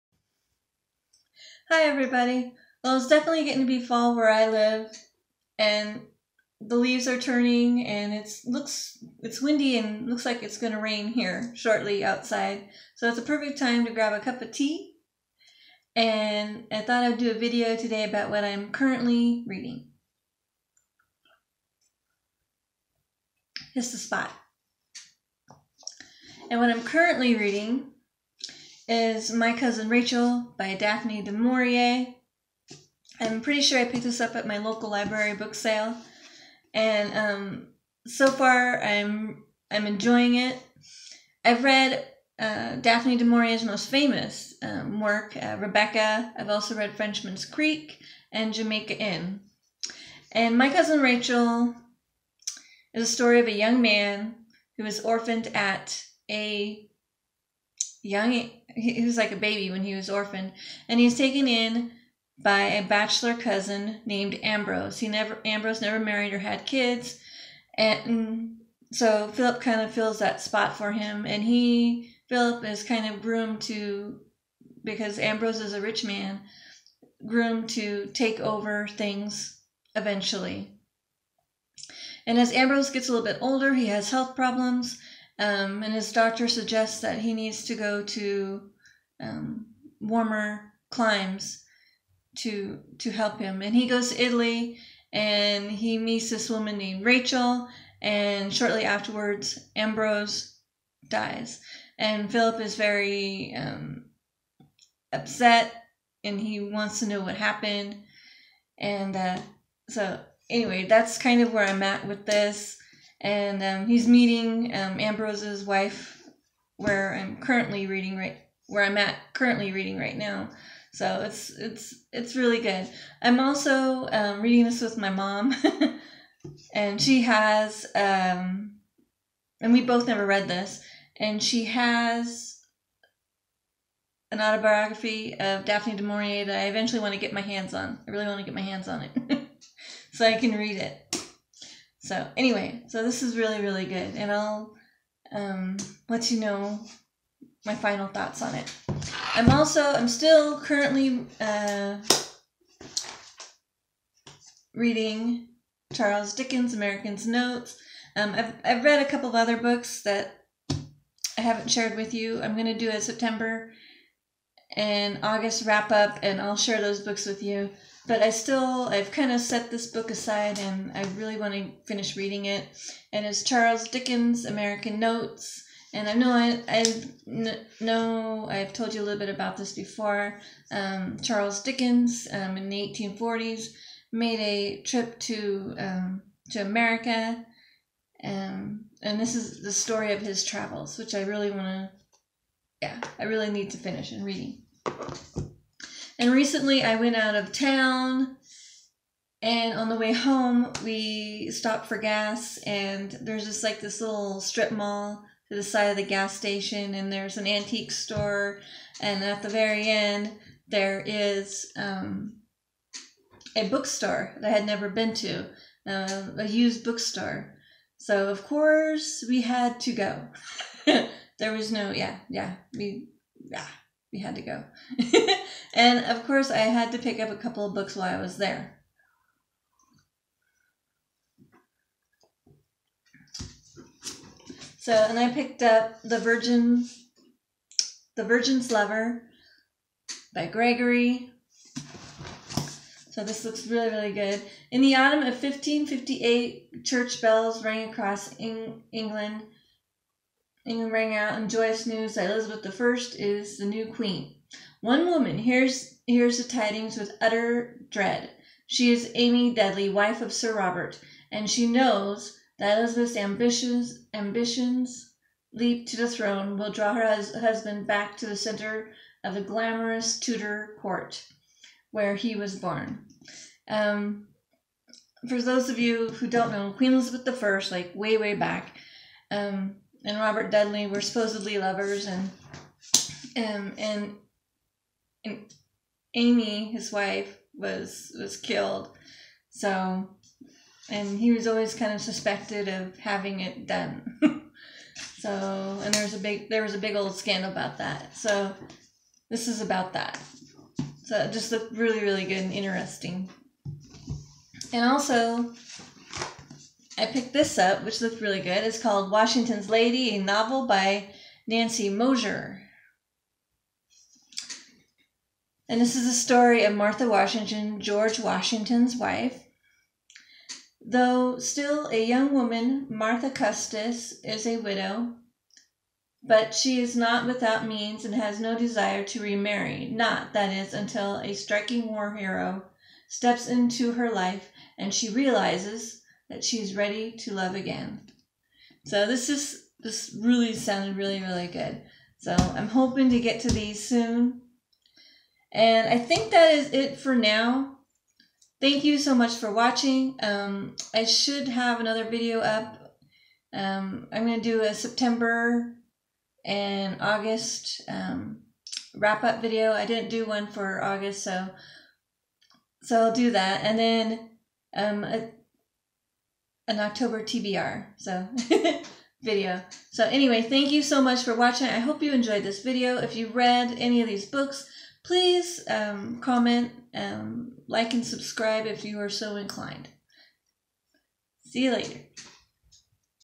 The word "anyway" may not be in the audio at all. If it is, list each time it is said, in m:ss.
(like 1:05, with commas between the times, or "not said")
1:50, 2:22, 6:10.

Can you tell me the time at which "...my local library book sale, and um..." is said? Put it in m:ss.
0:34.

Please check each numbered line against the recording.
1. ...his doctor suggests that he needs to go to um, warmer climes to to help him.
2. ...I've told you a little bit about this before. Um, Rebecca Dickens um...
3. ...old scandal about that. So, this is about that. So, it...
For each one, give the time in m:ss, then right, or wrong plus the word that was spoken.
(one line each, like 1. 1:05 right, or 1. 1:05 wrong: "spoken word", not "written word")
1. 1:25 right
2. 2:58 wrong: "Charles", not "Rebecca"
3. 4:56 right.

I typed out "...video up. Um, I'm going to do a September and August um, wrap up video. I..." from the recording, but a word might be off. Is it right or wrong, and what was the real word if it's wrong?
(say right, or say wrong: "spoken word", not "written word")
right.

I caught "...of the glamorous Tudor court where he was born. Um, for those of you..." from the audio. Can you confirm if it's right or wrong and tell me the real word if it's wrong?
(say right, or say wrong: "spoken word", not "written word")
right.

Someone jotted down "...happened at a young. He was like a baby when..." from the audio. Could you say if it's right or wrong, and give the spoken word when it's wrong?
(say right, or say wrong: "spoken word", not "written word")
wrong: "orphaned", not "happened".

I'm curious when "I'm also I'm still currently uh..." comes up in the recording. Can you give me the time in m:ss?
2:29.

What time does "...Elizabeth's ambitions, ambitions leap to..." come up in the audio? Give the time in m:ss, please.
4:22.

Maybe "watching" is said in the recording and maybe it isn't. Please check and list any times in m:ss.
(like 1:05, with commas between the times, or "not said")
5:49, 6:11.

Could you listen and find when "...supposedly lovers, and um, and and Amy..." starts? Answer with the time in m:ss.
4:41.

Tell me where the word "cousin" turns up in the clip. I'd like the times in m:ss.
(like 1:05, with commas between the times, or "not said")
0:29, 0:50, 1:03.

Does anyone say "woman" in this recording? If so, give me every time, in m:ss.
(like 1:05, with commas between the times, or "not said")
1:36, 4:15, 5:22.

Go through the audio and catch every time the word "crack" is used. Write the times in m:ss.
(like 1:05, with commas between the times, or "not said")
not said.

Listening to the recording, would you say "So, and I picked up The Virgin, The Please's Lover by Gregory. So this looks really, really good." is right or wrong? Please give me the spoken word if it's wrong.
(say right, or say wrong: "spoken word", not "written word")
wrong: "Virgin", not "Please".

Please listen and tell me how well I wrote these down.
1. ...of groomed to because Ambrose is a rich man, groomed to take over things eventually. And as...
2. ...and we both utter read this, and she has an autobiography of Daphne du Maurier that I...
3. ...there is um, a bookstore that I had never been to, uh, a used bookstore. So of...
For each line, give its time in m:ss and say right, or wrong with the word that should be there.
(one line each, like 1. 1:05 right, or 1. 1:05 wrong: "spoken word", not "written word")
1. 1:13 right
2. 2:09 wrong: "never", not "utter"
3. 3:30 right.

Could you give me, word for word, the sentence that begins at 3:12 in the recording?
Yeah, I really need to finish and reading.